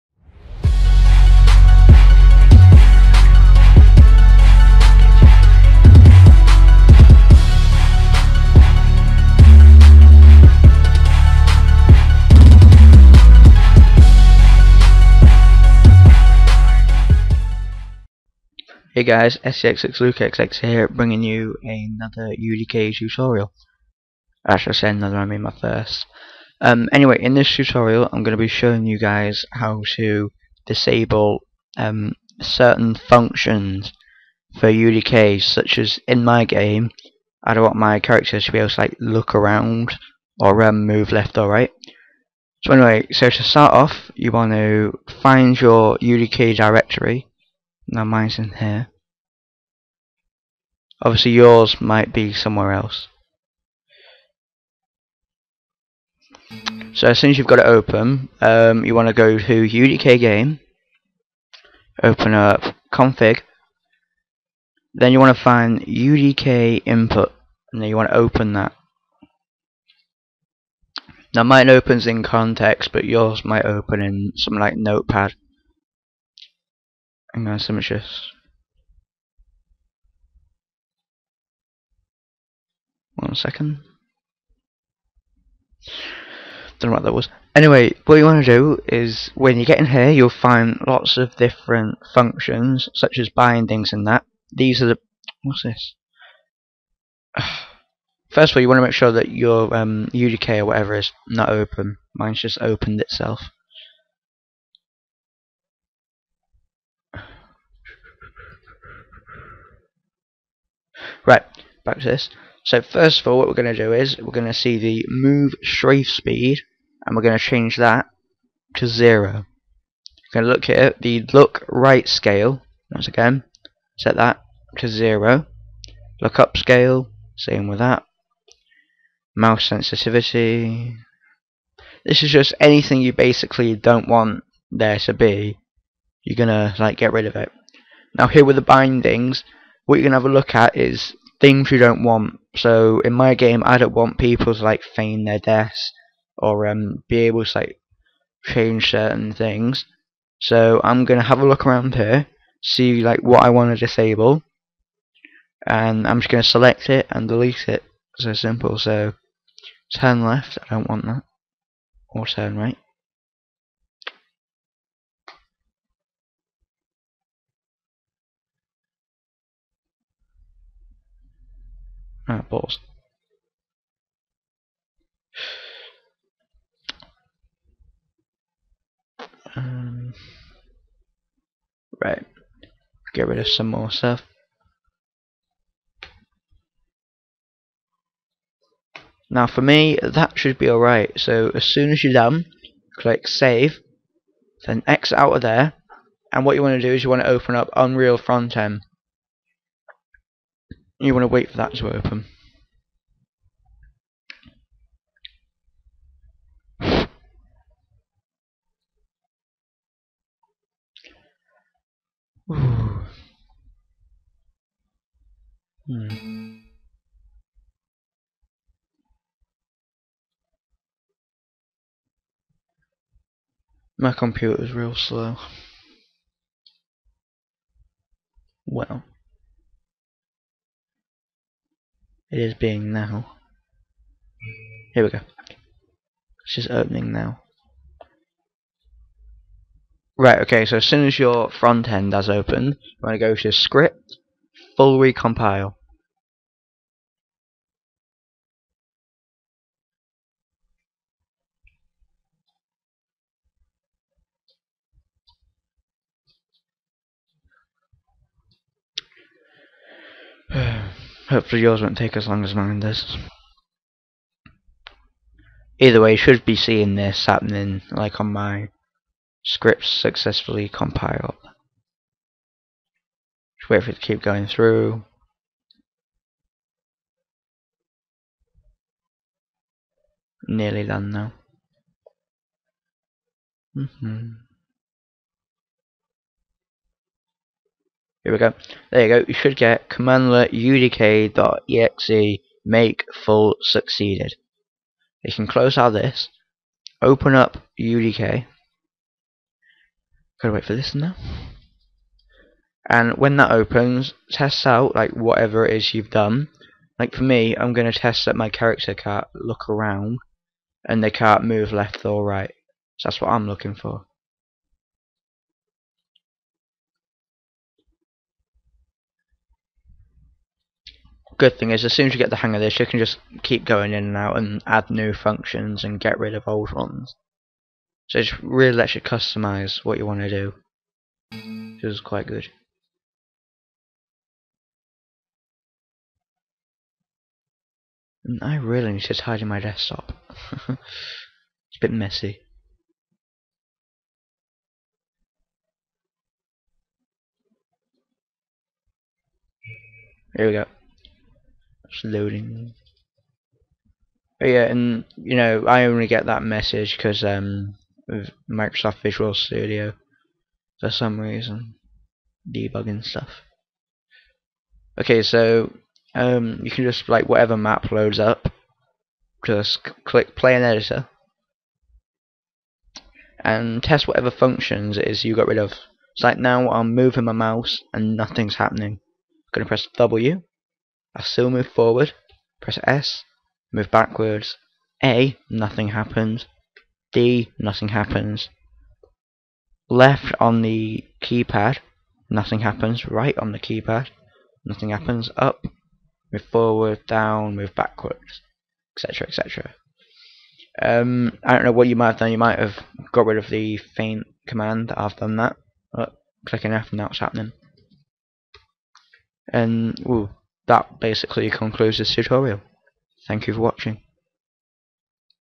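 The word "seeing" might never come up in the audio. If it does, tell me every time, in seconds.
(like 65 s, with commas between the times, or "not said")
266 s.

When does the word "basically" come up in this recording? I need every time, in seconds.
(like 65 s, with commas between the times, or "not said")
133 s, 411 s.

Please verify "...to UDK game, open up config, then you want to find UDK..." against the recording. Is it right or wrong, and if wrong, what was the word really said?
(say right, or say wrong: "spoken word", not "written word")
right.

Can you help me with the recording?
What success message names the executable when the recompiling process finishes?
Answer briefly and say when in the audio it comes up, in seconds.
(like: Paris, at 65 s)
udk.exe make full succeeded, at 289 s.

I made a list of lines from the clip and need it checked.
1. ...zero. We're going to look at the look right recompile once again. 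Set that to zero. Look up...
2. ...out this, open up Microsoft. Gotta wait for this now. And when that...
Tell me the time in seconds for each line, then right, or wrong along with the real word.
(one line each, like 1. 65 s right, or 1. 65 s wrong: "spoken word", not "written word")
1. 118 s wrong: "scale", not "recompile"
2. 295 s wrong: "UDK", not "Microsoft".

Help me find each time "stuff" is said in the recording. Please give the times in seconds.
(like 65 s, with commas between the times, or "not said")
183 s, 363 s.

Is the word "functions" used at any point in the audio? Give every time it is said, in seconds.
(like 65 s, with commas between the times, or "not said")
32 s, 92 s, 325 s, 374 s.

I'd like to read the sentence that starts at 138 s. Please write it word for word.
Now here with the bindings, what you're gonna have a look at is things you don't want.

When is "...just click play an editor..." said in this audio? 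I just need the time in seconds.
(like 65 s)
369 s.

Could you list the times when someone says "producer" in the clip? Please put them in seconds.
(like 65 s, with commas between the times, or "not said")
not said.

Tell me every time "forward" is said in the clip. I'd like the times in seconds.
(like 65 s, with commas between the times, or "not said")
381 s, 396 s.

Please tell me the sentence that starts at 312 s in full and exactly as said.
So that's what I'm looking for.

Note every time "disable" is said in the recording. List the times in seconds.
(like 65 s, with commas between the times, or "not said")
30 s, 153 s.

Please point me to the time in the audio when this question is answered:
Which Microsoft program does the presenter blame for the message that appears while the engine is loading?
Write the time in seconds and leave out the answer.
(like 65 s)
358 s.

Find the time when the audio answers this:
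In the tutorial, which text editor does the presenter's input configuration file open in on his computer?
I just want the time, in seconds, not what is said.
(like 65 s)
72 s.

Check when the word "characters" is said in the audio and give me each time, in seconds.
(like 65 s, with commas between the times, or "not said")
38 s, 308 s.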